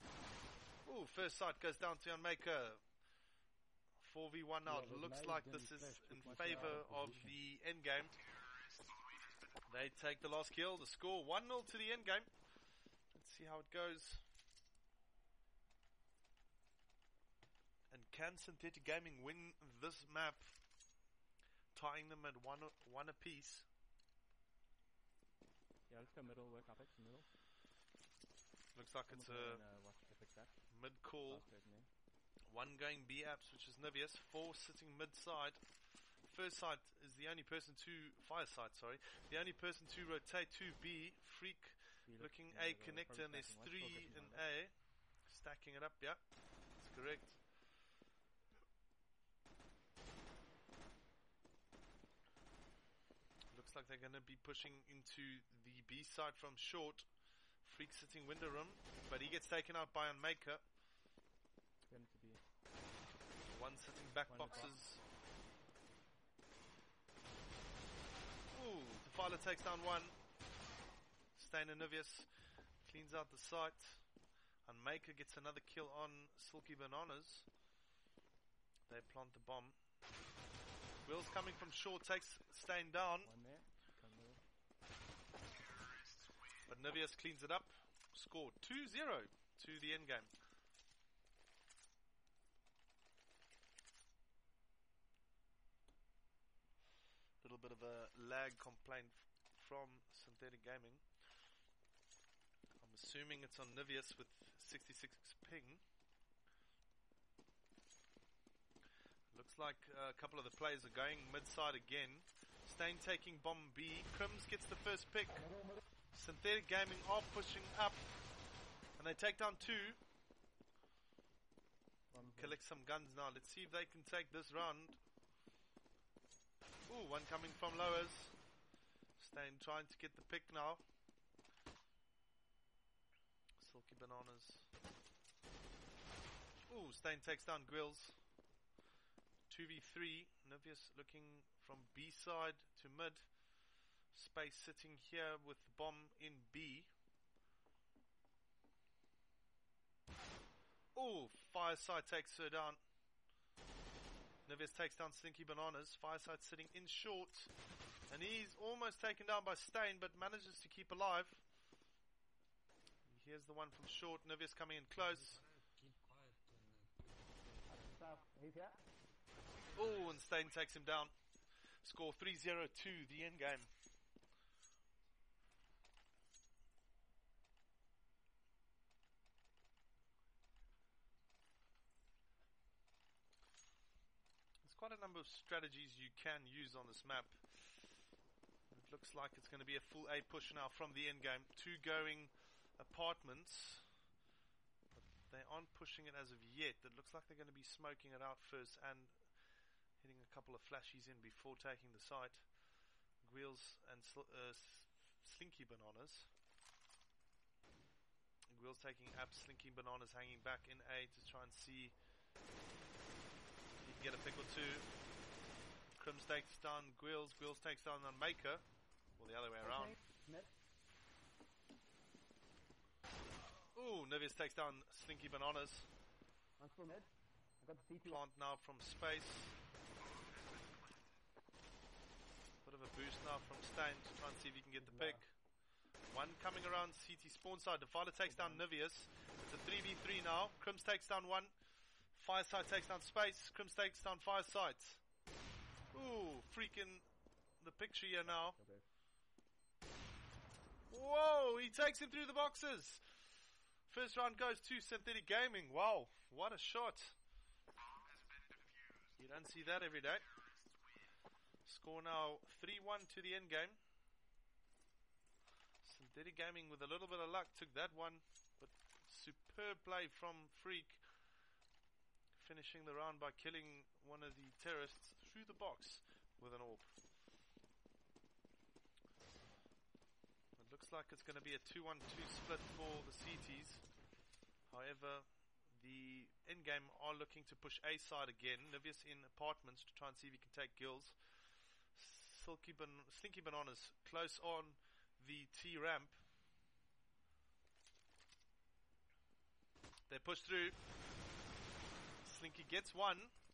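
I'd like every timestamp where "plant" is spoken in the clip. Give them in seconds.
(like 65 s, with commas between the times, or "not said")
78 s, 228 s.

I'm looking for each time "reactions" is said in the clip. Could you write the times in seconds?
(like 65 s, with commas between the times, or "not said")
not said.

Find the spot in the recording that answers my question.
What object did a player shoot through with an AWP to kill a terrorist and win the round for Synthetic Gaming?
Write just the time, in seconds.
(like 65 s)
252 s.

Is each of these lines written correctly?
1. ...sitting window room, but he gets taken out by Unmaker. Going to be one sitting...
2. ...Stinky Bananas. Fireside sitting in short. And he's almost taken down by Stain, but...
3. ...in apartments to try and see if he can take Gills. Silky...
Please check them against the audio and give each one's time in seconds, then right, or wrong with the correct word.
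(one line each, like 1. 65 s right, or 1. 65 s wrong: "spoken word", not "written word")
1. 57 s right
2. 155 s right
3. 289 s right.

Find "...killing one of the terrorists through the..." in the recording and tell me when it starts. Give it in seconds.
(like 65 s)
273 s.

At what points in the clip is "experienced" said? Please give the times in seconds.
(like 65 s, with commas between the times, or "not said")
not said.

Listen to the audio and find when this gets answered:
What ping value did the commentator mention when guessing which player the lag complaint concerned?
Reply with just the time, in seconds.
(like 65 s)
104 s.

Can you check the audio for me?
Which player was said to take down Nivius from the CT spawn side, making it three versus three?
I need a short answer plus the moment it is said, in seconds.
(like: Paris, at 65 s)
Defiler, at 237 s.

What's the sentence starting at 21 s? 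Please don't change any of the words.
Tying them at one, one apiece.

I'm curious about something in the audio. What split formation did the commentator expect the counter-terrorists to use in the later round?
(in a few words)
2-1-2.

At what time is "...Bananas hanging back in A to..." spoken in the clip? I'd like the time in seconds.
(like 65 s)
209 s.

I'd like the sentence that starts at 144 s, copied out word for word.
Space sitting here with bomb in B.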